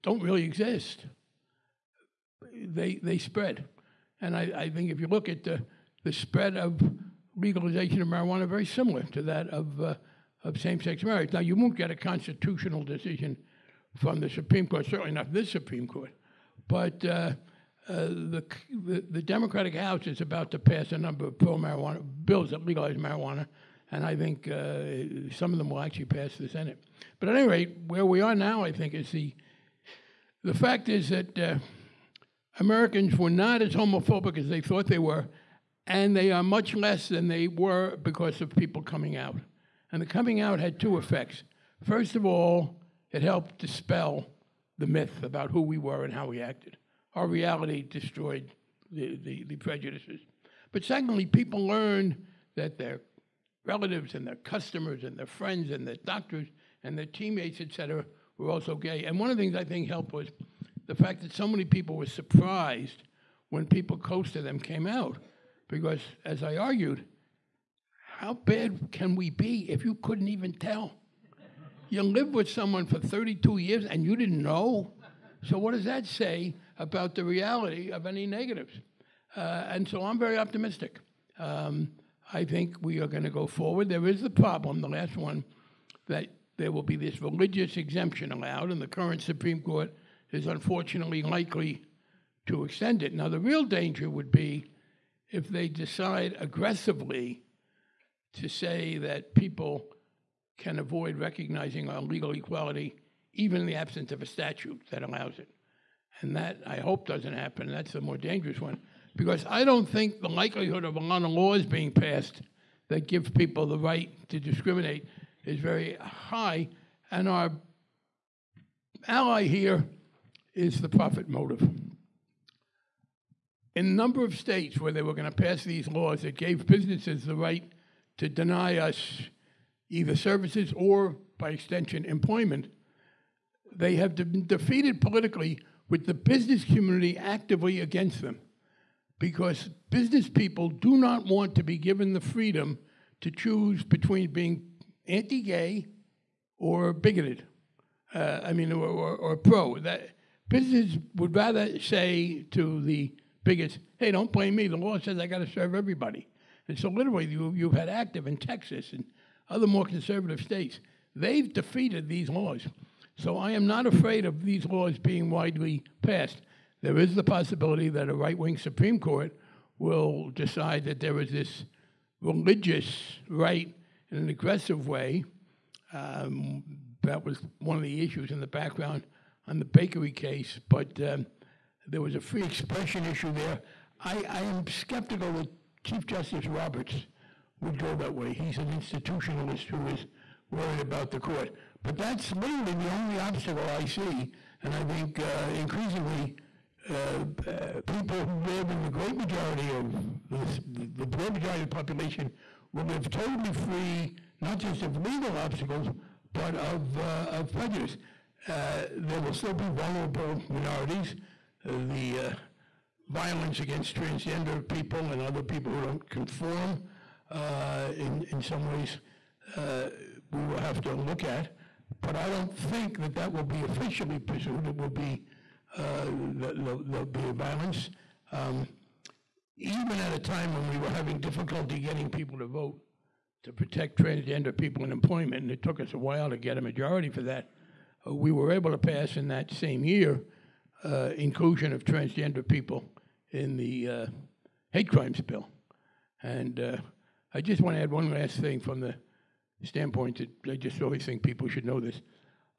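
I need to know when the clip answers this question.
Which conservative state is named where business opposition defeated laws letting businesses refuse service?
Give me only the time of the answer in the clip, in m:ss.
2:38.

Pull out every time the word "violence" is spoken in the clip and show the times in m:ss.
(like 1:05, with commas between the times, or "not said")
3:33, 3:47.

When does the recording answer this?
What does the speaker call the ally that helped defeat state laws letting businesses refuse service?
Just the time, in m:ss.
2:00.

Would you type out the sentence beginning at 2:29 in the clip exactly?
That business would rather say to the bigots, hey, don't blame me.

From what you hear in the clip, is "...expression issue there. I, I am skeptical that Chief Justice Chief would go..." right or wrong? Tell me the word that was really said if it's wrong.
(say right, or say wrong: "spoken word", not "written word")
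wrong: "Roberts", not "Chief".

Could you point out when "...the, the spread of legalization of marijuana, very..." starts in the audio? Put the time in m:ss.
0:05.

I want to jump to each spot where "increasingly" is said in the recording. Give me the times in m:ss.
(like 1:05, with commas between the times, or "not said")
3:15.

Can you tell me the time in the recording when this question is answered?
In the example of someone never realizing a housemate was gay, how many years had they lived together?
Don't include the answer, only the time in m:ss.
1:12.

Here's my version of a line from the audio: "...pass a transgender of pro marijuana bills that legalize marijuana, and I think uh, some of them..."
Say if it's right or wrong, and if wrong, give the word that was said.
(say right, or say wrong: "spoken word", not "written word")
wrong: "number", not "transgender".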